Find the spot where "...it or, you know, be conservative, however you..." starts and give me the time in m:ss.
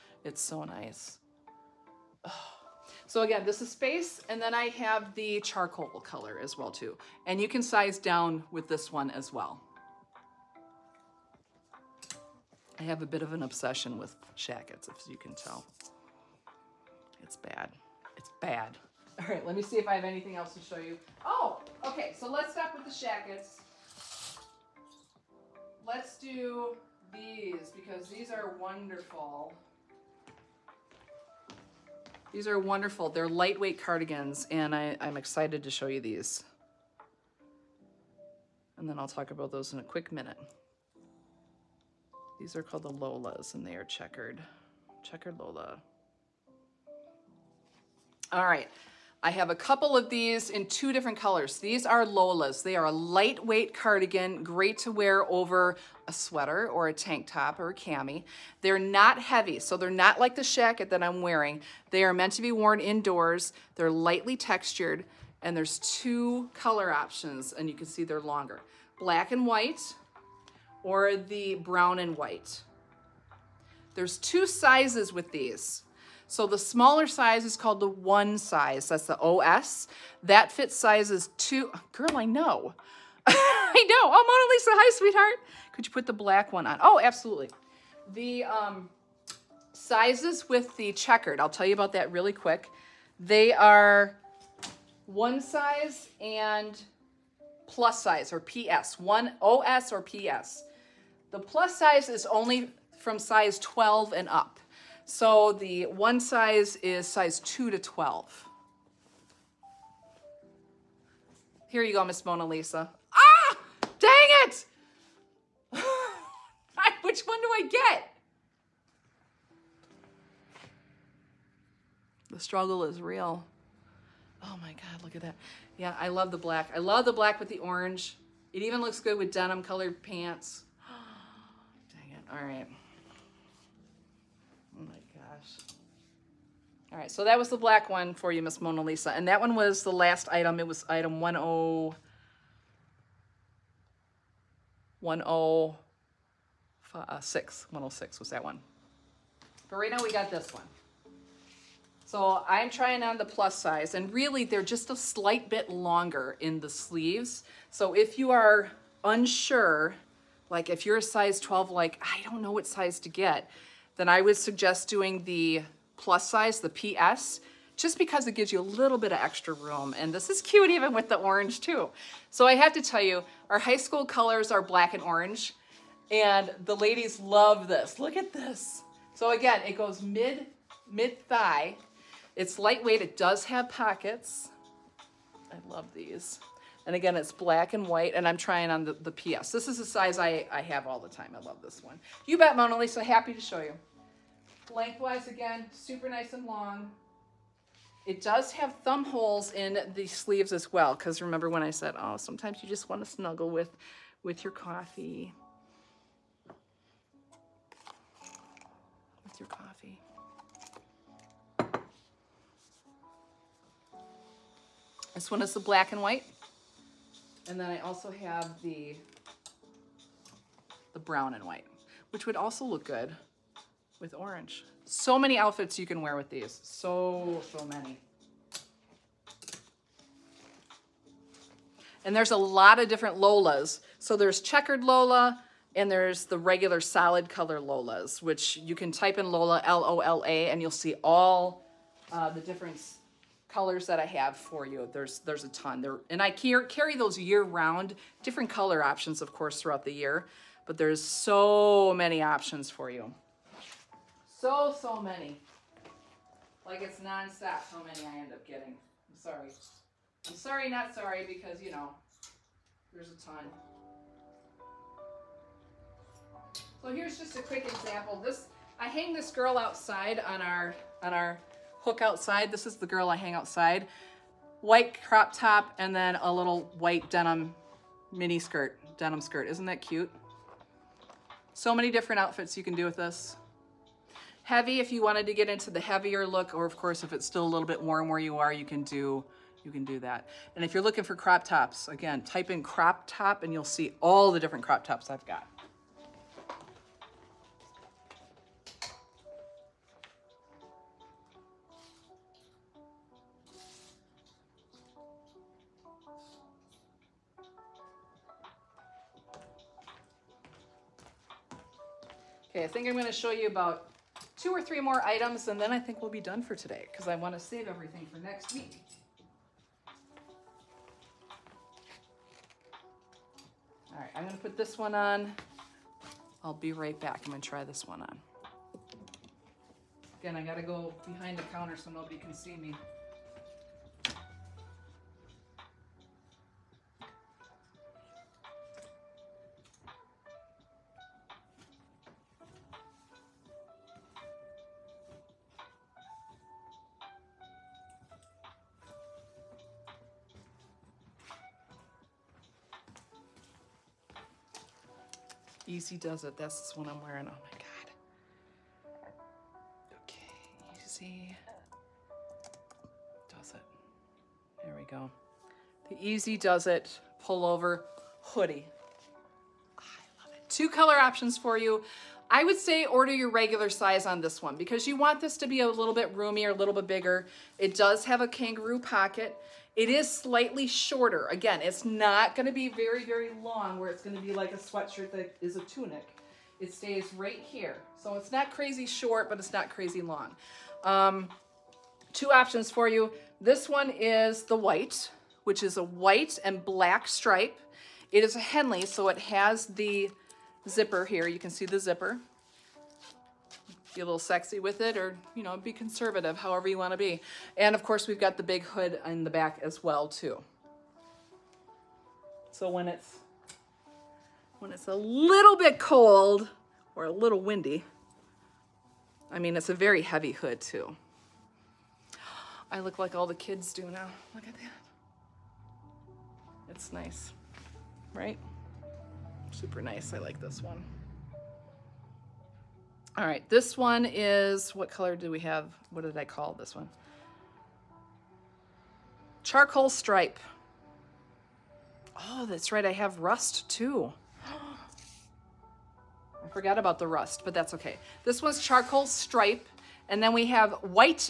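6:44.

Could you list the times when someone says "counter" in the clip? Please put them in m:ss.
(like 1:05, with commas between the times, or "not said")
5:31.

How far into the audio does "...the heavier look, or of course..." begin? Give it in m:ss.
4:45.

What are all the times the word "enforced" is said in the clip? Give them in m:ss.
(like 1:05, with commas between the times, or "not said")
not said.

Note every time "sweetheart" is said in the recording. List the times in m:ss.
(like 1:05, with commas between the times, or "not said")
1:24.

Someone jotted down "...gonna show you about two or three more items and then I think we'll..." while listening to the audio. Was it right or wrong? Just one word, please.
right.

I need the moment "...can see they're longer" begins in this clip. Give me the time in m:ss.
1:07.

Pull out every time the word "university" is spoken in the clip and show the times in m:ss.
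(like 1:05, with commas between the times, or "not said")
not said.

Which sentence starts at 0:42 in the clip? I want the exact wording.
These are called the Lolas and they are checkered.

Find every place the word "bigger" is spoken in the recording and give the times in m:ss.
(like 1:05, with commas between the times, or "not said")
6:16.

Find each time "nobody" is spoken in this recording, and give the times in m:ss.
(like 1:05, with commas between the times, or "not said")
5:31.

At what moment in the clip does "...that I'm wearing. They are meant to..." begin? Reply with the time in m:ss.
1:00.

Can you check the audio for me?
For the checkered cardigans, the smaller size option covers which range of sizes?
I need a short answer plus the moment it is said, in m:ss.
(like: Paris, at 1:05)
2 to 12, at 1:47.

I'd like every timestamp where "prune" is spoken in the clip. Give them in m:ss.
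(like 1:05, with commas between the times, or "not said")
not said.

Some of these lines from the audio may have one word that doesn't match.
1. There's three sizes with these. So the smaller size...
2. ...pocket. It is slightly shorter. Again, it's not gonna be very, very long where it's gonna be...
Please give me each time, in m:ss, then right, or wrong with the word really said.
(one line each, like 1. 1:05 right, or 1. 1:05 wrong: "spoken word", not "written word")
1. 1:13 wrong: "two", not "three"
2. 6:18 right.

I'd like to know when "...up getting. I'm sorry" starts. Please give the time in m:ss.
4:18.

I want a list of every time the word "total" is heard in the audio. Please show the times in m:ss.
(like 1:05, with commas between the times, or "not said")
not said.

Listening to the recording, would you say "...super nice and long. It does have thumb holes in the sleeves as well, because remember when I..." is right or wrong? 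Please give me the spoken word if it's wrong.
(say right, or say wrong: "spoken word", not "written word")
right.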